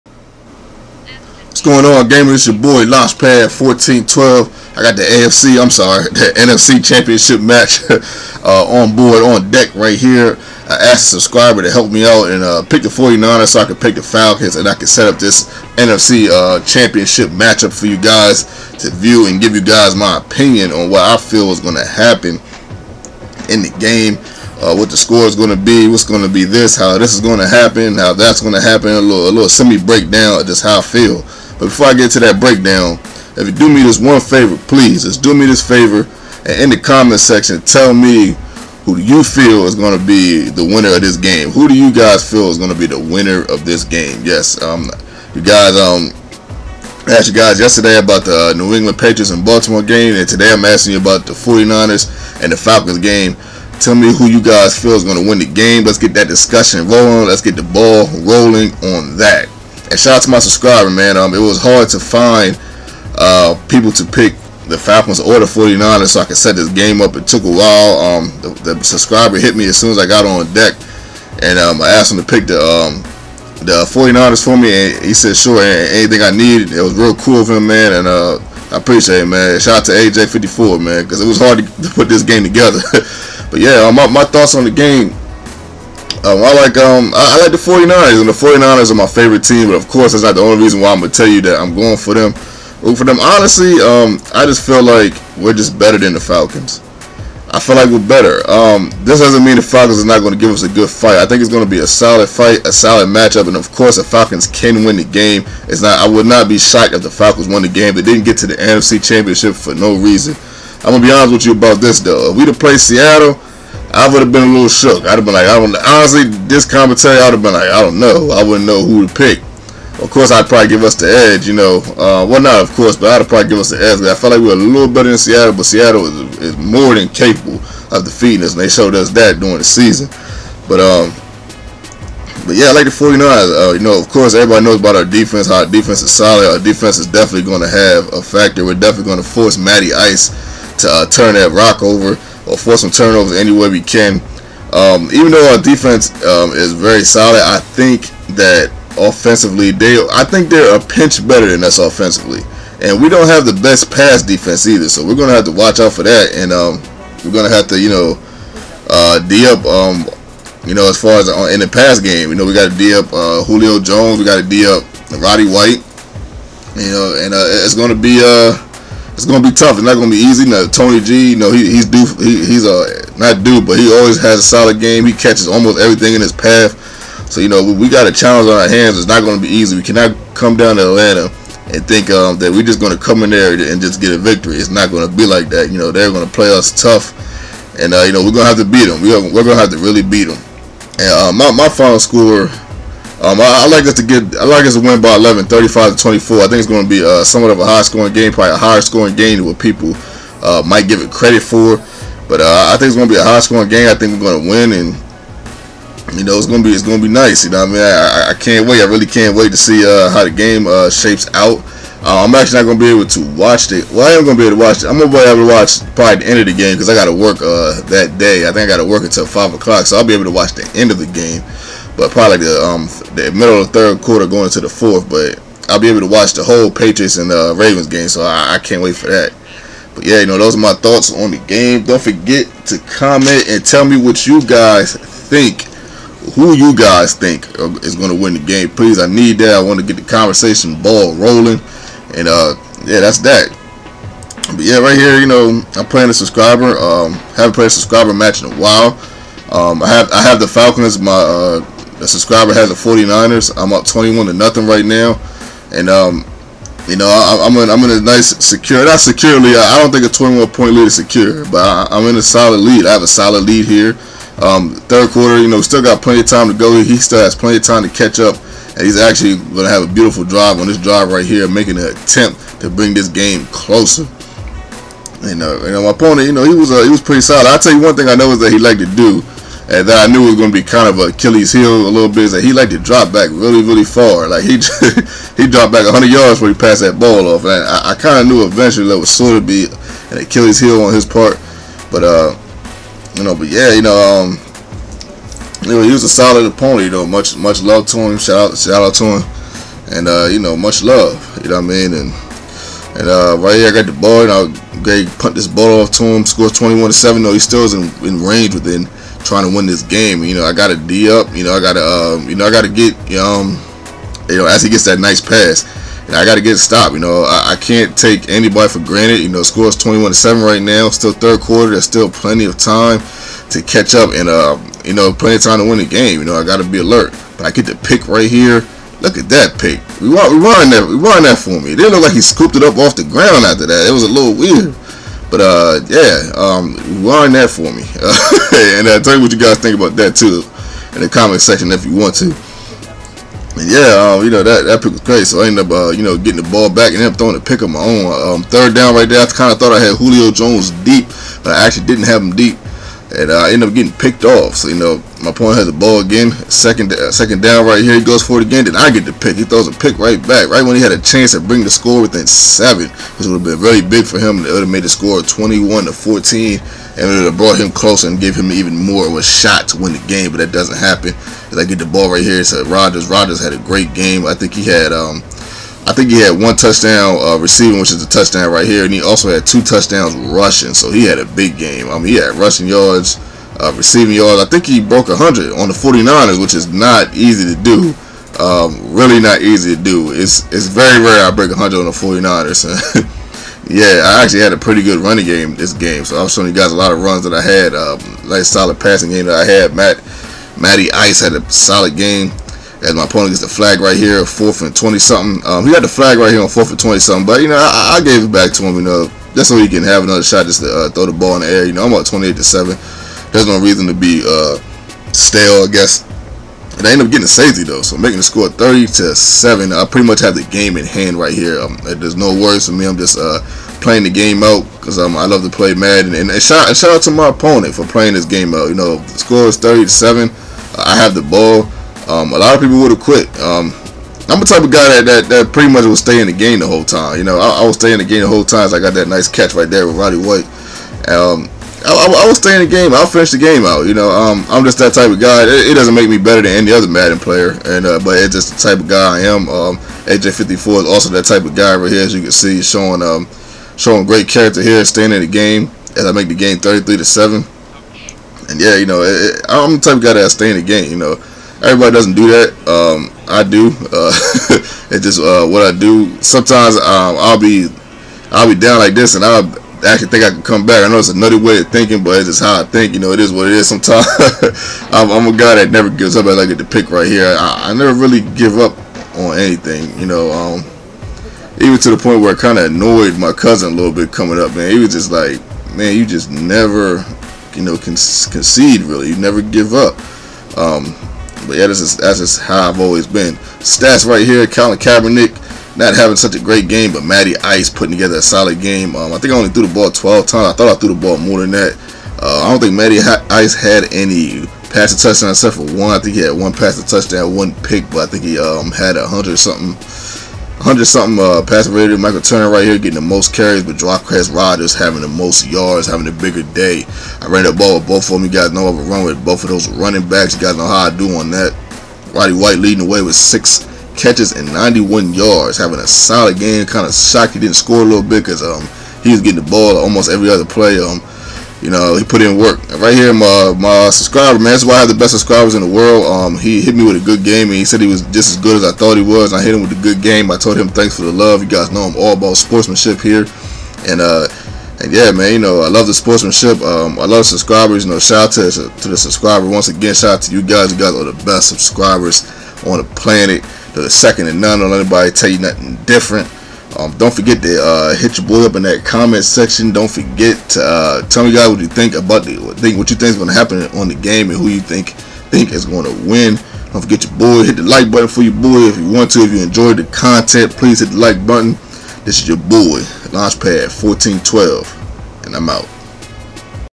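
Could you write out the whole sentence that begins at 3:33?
Well, I am going to be able to watch it.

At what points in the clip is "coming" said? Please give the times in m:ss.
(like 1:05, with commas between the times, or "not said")
8:04.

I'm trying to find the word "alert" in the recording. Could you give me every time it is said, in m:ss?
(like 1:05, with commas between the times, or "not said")
5:26.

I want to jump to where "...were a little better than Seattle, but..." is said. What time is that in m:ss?
2:04.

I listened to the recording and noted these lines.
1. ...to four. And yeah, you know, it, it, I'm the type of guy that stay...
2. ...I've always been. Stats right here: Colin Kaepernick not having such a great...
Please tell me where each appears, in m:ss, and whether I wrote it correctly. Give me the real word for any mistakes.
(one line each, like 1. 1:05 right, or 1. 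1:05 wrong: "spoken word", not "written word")
1. 7:36 wrong: "seven", not "four"
2. 8:12 right.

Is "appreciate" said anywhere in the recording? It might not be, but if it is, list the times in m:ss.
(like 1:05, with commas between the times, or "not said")
1:18.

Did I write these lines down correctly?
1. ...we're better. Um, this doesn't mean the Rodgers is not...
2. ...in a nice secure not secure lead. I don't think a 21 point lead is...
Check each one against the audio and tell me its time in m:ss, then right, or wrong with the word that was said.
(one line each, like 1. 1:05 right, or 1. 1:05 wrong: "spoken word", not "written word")
1. 1:37 wrong: "Falcons", not "Rodgers"
2. 4:17 right.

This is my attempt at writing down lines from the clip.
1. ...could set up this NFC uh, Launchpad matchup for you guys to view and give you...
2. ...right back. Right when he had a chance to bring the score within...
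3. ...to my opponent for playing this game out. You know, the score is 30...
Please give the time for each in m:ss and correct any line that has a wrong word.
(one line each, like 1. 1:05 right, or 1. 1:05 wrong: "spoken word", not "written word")
1. 0:14 wrong: "Championship", not "Launchpad"
2. 5:59 right
3. 7:07 right.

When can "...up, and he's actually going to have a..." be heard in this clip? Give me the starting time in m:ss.
4:28.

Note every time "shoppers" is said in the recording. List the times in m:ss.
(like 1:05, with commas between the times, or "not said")
not said.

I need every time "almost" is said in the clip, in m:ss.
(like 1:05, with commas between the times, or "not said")
2:55, 8:49.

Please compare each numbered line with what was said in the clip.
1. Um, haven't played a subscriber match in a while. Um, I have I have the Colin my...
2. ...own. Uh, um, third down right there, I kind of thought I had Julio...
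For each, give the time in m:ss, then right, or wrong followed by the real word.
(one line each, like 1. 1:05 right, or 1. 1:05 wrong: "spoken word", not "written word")
1. 4:06 wrong: "Falcons", not "Colin"
2. 5:47 right.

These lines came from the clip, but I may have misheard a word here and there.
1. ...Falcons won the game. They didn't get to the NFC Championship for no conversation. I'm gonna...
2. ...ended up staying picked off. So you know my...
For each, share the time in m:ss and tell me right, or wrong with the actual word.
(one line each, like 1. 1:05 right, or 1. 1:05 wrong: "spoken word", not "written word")
1. 1:47 wrong: "reason", not "conversation"
2. 5:53 wrong: "getting", not "staying".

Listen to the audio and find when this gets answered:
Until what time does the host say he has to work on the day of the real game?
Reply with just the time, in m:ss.
3:39.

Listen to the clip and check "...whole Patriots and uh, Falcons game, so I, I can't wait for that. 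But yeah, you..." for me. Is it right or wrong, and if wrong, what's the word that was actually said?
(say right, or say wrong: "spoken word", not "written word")
wrong: "Ravens", not "Falcons".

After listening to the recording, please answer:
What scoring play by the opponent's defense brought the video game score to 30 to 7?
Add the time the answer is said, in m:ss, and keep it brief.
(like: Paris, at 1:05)
A safety, at 6:57.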